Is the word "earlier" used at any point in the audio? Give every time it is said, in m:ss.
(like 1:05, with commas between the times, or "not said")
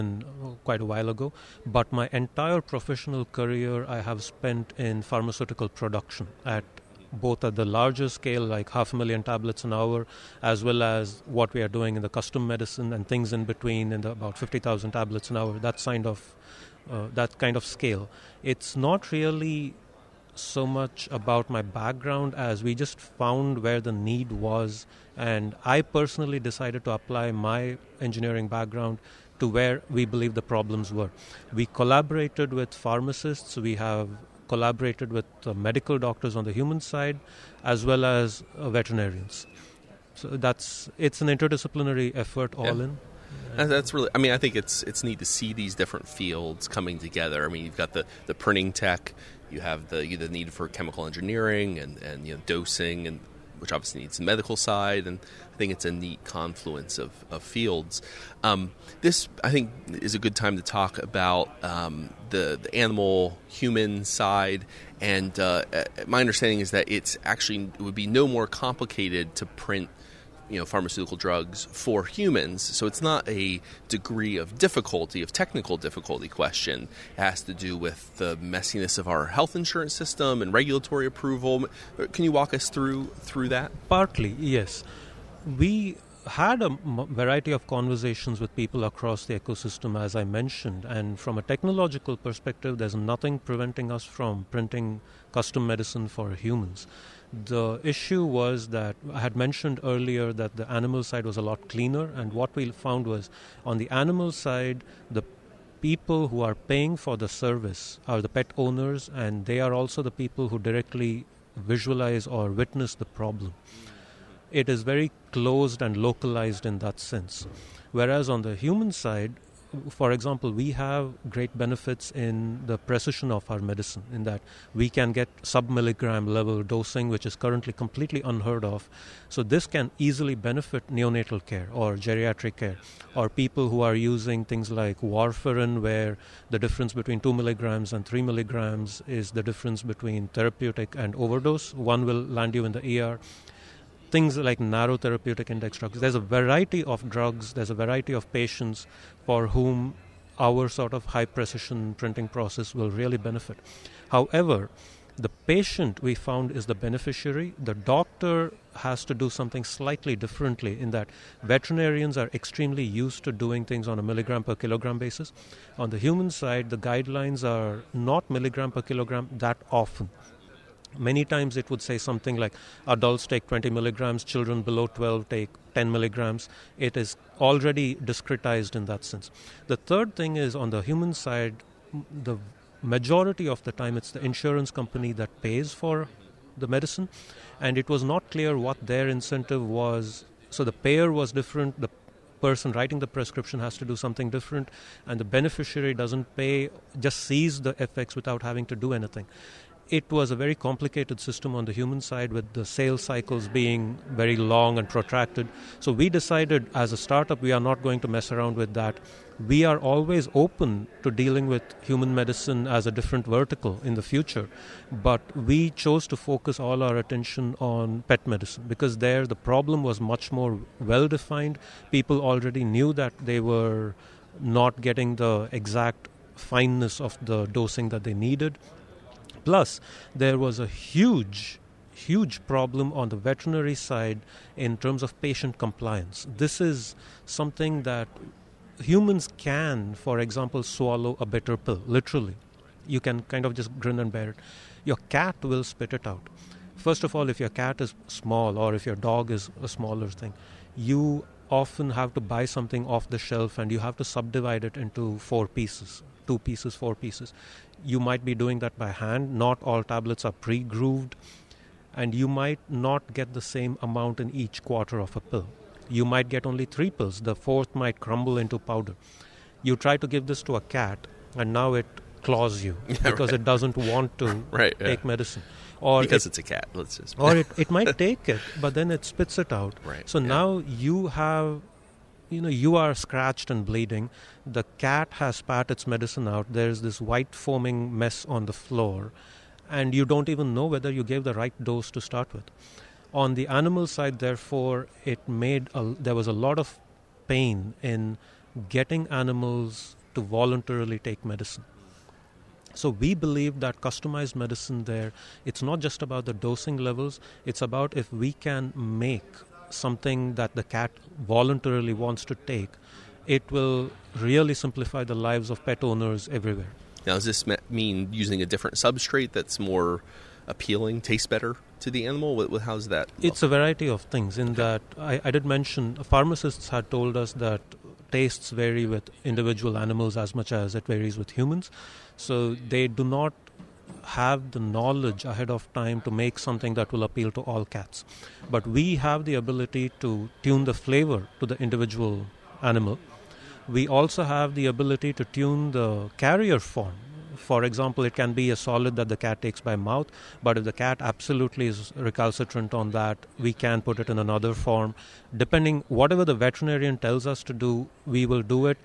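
1:39.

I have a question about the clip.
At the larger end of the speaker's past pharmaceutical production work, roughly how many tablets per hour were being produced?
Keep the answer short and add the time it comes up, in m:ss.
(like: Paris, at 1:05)
500,000, at 0:08.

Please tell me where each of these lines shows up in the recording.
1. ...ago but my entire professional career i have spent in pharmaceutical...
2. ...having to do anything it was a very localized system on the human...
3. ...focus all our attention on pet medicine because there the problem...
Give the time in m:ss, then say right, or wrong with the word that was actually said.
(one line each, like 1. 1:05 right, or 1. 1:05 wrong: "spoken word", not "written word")
1. 0:01 right
2. 3:18 wrong: "complicated", not "localized"
3. 3:36 right.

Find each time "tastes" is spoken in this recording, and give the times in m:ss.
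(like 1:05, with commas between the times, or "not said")
5:21, 5:28.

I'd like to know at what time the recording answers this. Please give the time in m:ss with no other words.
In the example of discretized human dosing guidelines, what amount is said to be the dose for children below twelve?
2:55.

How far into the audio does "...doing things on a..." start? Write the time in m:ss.
2:43.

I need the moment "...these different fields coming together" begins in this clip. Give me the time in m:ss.
0:45.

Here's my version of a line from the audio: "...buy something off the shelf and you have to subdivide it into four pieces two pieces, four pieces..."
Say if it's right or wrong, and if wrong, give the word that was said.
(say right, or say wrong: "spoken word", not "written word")
right.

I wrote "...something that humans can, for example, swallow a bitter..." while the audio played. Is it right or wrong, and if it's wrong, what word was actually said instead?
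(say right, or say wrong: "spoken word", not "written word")
right.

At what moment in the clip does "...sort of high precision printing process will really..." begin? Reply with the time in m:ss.
2:30.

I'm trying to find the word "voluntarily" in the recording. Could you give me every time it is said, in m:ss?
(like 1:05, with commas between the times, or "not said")
5:00, 5:11.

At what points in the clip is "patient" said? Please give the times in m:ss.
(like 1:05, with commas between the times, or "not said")
2:28, 2:35, 3:55.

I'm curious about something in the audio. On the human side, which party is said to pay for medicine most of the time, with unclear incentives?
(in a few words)
insurance company.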